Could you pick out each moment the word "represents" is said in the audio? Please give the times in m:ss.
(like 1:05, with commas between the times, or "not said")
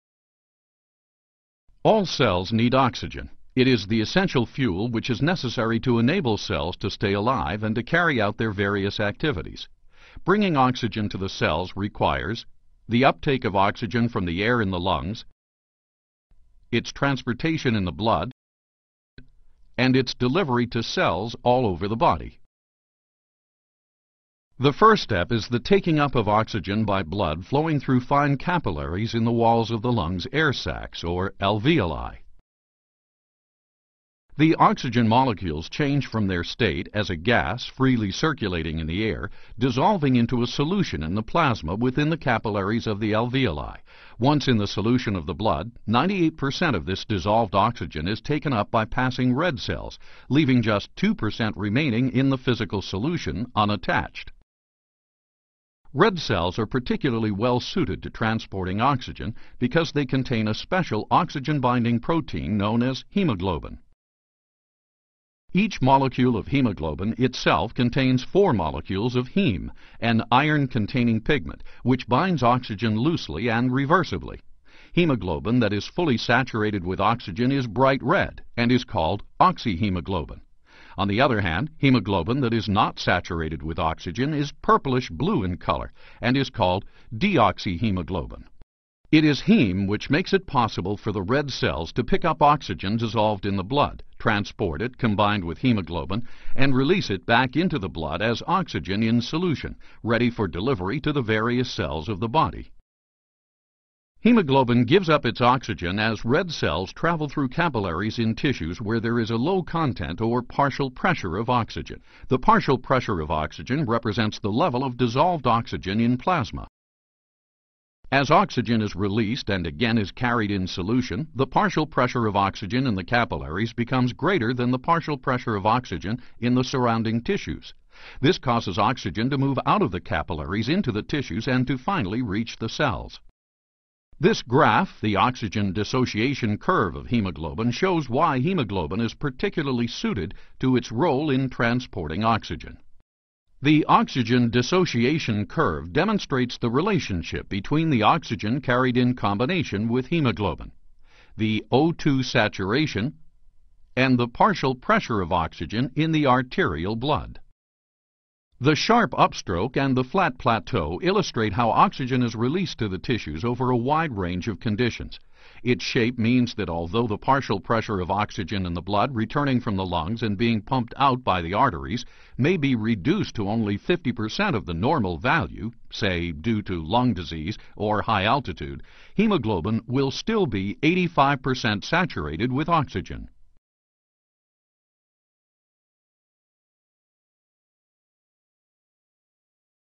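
1:53.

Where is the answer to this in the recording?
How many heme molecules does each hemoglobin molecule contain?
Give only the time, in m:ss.
1:08.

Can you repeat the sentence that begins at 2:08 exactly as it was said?
This causes oxygen to move out of the capillaries into the tissues and to finally reach the cells.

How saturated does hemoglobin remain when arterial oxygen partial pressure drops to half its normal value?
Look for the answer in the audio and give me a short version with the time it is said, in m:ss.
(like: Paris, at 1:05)
85%, at 3:00.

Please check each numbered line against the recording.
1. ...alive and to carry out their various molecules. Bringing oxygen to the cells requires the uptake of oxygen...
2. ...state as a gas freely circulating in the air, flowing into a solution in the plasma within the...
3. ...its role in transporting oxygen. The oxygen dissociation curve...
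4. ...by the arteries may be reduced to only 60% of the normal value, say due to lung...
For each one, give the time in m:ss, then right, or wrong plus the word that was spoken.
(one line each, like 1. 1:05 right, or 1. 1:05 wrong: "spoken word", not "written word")
1. 0:07 wrong: "activities", not "molecules"
2. 0:36 wrong: "dissolving", not "flowing"
3. 2:20 right
4. 2:51 wrong: "50", not "60".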